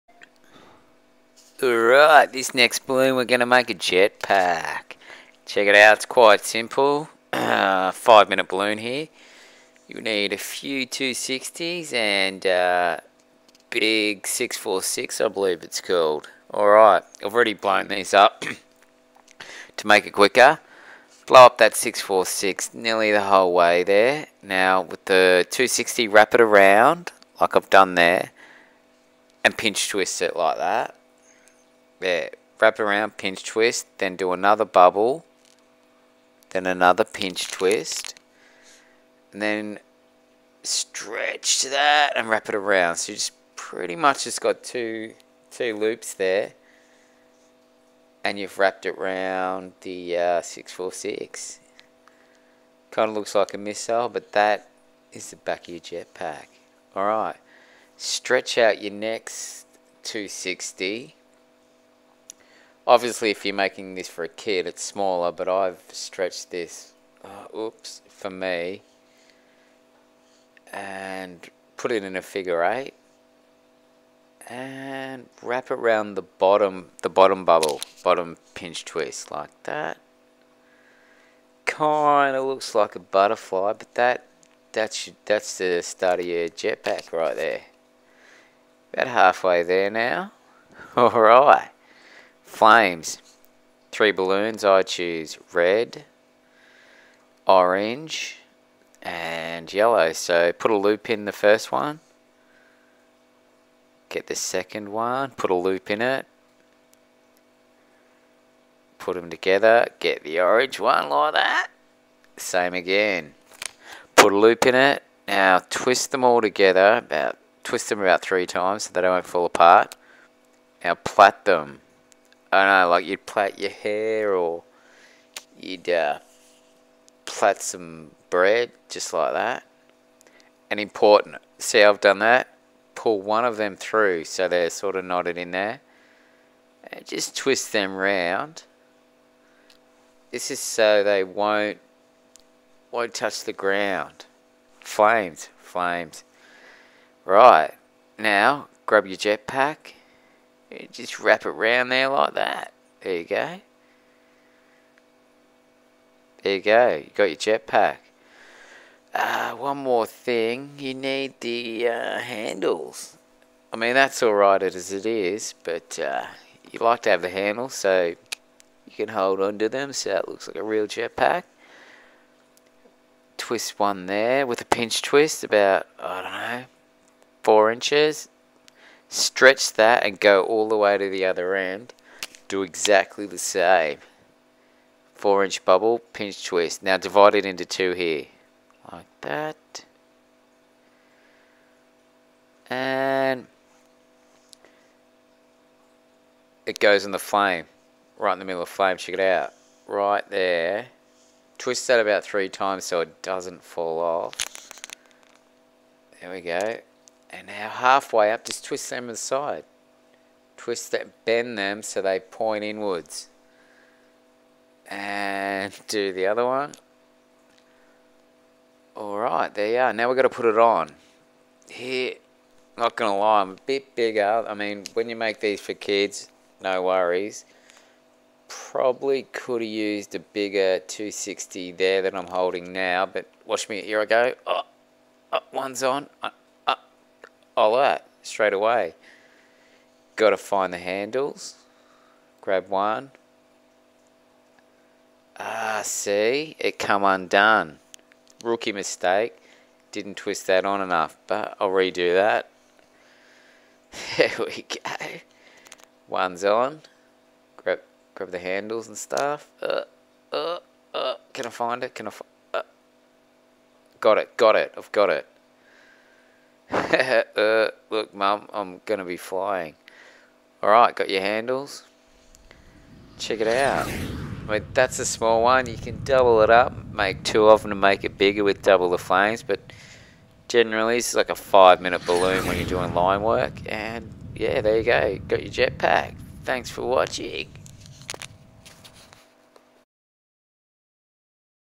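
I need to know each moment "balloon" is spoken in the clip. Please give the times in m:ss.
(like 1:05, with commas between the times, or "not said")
0:02, 0:08, 1:34, 4:42.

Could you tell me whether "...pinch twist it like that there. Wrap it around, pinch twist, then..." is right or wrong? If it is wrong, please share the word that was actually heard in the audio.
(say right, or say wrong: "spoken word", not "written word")
right.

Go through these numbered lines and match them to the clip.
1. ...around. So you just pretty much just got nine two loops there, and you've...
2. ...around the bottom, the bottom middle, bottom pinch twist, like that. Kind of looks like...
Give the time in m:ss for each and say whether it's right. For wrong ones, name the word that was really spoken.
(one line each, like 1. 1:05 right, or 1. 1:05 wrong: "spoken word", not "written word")
1. 0:42 wrong: "two", not "nine"
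2. 1:15 wrong: "bubble", not "middle".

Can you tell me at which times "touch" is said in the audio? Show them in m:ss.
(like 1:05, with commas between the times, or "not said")
2:23.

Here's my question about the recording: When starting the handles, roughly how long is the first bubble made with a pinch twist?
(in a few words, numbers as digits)
4 inches.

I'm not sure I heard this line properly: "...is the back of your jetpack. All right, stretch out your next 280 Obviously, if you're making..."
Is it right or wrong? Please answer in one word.
wrong.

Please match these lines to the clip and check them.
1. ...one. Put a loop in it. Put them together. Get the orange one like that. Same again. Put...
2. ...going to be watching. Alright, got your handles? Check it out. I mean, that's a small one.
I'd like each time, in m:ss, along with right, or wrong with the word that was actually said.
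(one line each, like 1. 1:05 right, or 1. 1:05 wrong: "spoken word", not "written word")
1. 1:44 right
2. 4:28 wrong: "flying", not "watching".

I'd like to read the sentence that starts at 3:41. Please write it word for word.
Here, not going to lie, I'm a bit bigger.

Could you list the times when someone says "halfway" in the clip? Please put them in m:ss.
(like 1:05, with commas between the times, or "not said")
1:29, 3:27.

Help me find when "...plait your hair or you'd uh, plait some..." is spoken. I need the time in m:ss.
2:03.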